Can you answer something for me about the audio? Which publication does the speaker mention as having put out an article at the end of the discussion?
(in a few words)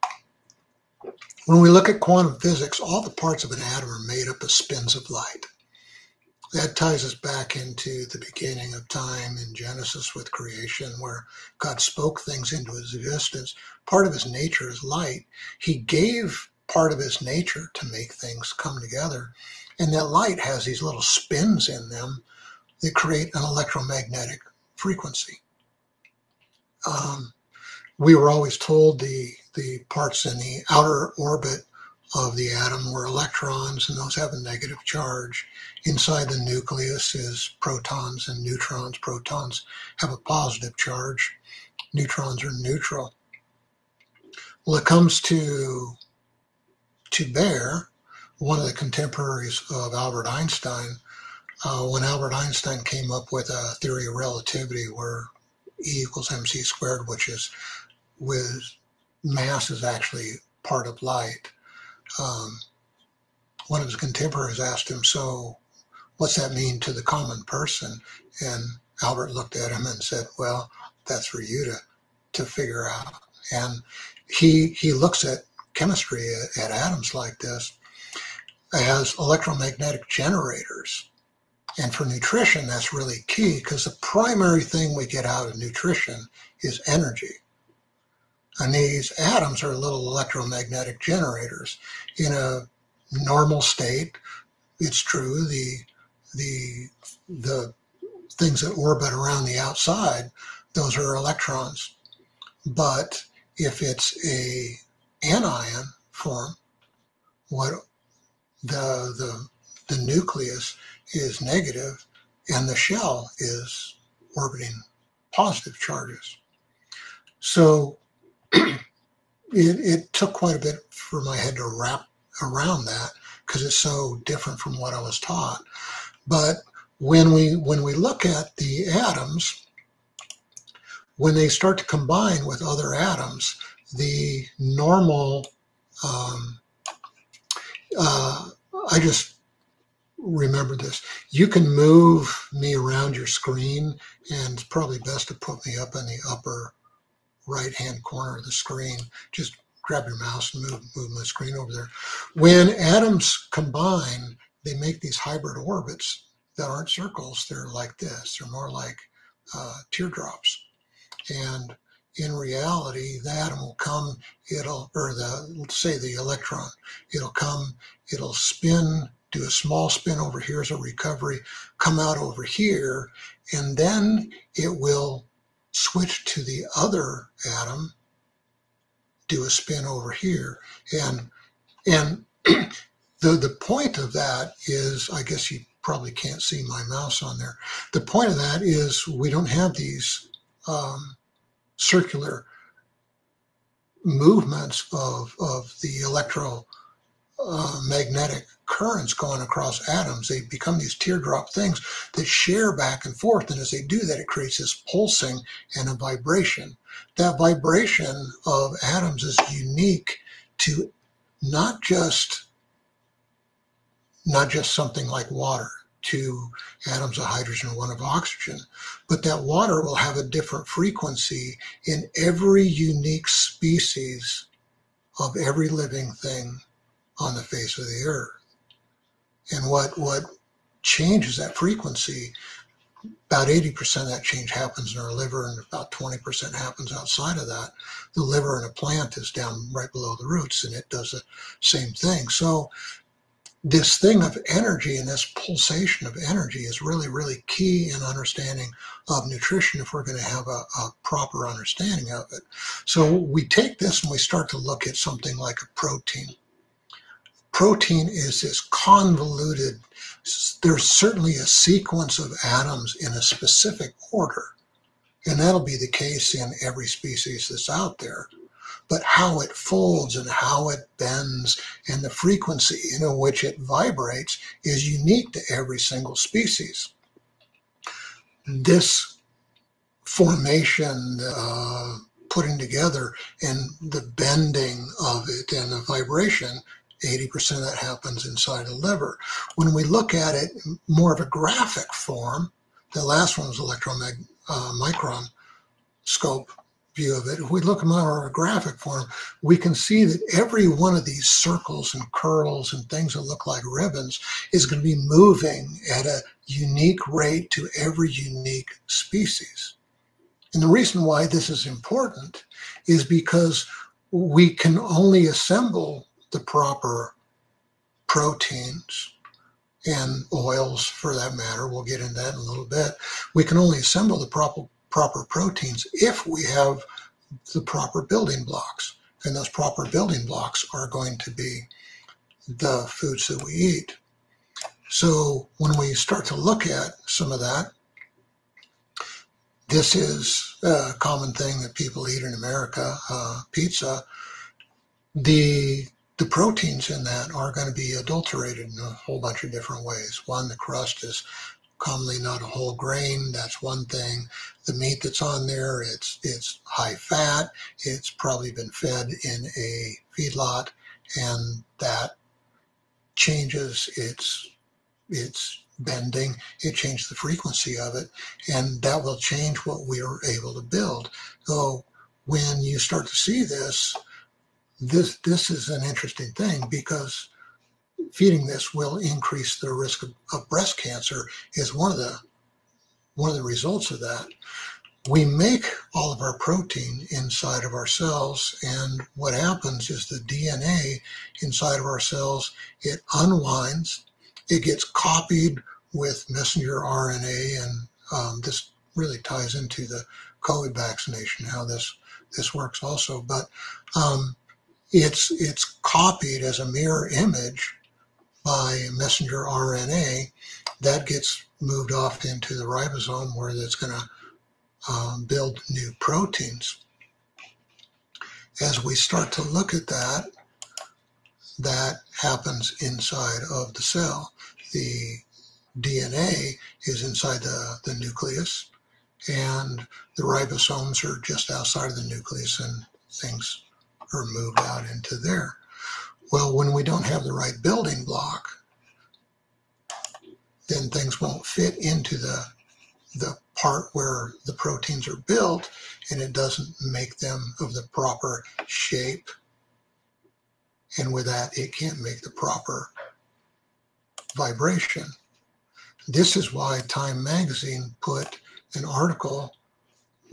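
Time Magazine.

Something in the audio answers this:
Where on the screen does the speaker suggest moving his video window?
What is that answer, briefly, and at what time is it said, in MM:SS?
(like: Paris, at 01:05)
Upper right hand corner, at 02:26.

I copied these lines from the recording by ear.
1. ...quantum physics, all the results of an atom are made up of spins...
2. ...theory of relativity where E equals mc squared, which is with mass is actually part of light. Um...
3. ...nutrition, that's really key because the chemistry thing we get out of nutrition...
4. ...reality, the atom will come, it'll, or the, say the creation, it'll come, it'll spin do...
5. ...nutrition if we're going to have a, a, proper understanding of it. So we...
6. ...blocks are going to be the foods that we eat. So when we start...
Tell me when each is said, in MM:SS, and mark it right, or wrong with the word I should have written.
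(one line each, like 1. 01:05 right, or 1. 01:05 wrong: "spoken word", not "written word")
1. 00:01 wrong: "parts", not "results"
2. 00:53 right
3. 01:22 wrong: "primary", not "chemistry"
4. 02:42 wrong: "electron", not "creation"
5. 04:09 right
6. 05:30 right.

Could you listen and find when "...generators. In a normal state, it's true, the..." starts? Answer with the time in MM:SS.
01:30.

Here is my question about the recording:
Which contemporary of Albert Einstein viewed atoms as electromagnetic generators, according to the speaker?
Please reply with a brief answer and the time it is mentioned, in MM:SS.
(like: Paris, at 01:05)
Baer, at 00:47.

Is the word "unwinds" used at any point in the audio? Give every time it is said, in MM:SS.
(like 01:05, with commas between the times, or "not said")
06:33.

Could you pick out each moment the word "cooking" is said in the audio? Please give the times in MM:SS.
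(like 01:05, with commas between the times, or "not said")
not said.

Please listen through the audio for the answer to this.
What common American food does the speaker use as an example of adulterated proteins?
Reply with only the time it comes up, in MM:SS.
05:43.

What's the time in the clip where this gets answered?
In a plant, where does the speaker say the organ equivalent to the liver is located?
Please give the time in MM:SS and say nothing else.
03:59.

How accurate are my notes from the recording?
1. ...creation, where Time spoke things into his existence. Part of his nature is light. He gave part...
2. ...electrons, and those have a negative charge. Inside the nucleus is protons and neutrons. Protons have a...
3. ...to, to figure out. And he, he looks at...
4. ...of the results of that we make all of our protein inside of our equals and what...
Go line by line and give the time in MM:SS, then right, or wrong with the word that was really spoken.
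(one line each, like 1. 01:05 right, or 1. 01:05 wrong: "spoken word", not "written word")
1. 00:10 wrong: "God", not "Time"
2. 00:33 right
3. 01:11 right
4. 06:23 wrong: "cells", not "equals".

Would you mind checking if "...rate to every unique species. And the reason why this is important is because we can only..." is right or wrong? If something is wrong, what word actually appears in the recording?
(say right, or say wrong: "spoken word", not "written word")
right.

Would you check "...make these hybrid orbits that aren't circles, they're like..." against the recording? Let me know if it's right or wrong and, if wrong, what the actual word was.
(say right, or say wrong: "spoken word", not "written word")
right.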